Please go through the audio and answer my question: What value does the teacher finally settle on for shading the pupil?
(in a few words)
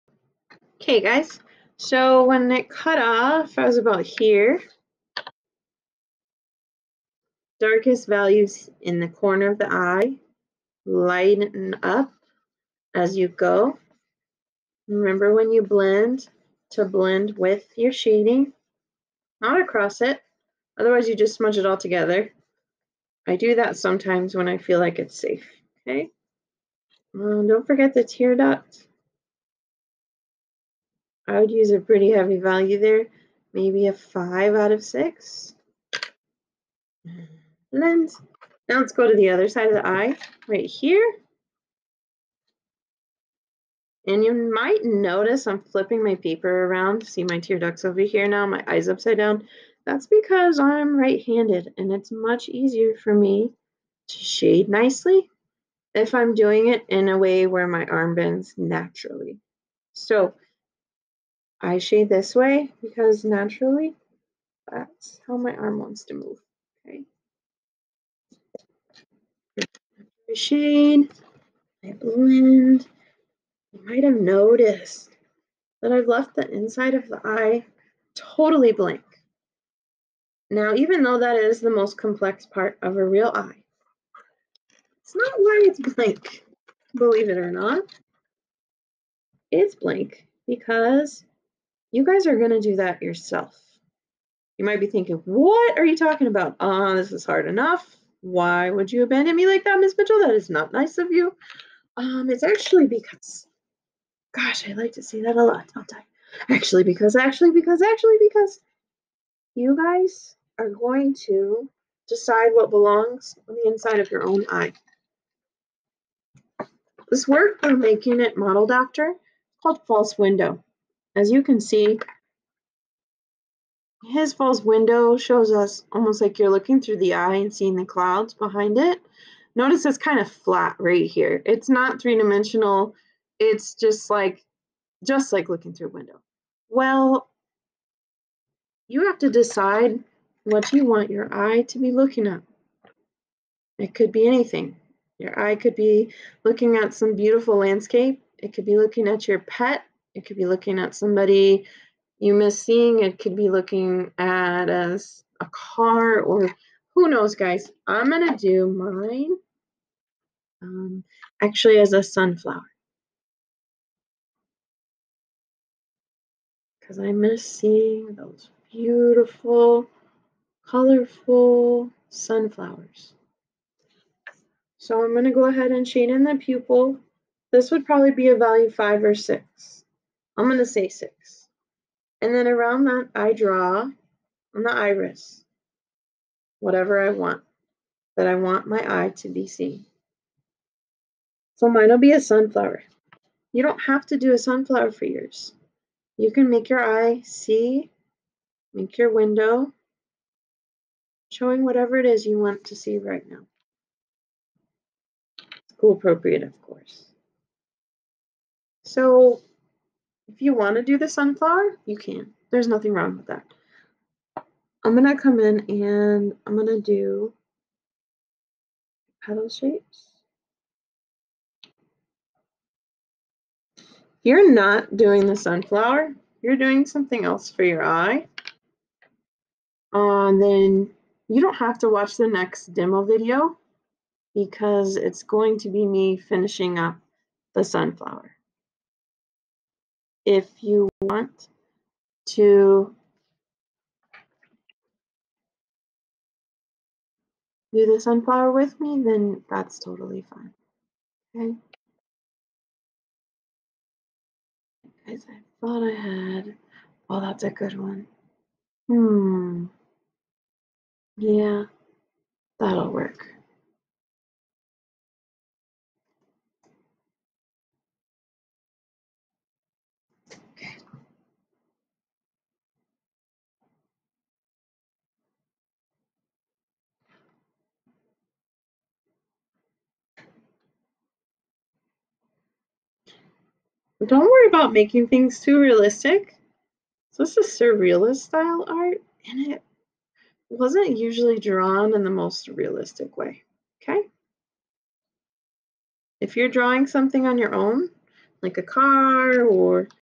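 6.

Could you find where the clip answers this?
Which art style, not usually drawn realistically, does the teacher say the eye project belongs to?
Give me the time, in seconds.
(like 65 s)
287 s.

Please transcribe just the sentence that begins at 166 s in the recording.
Because I miss seeing those beautiful, colorful sunflowers.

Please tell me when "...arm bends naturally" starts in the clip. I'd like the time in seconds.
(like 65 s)
57 s.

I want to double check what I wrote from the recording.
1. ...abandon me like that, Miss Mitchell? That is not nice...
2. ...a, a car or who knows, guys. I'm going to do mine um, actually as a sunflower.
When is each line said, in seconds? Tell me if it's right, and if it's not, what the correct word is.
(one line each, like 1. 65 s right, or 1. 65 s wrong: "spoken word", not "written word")
1. 99 s right
2. 154 s right.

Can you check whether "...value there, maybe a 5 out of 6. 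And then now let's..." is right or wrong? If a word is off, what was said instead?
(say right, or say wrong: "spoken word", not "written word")
right.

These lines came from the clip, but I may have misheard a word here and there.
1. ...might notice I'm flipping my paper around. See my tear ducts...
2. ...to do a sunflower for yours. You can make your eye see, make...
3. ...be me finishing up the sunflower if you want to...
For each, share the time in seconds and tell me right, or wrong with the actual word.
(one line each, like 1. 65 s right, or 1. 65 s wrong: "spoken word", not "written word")
1. 44 s right
2. 194 s right
3. 235 s right.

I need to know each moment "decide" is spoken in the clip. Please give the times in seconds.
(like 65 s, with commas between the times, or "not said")
112 s, 139 s.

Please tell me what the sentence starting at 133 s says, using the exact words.
It's just like just like looking through a window.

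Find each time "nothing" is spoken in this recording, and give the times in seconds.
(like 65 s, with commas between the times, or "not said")
212 s.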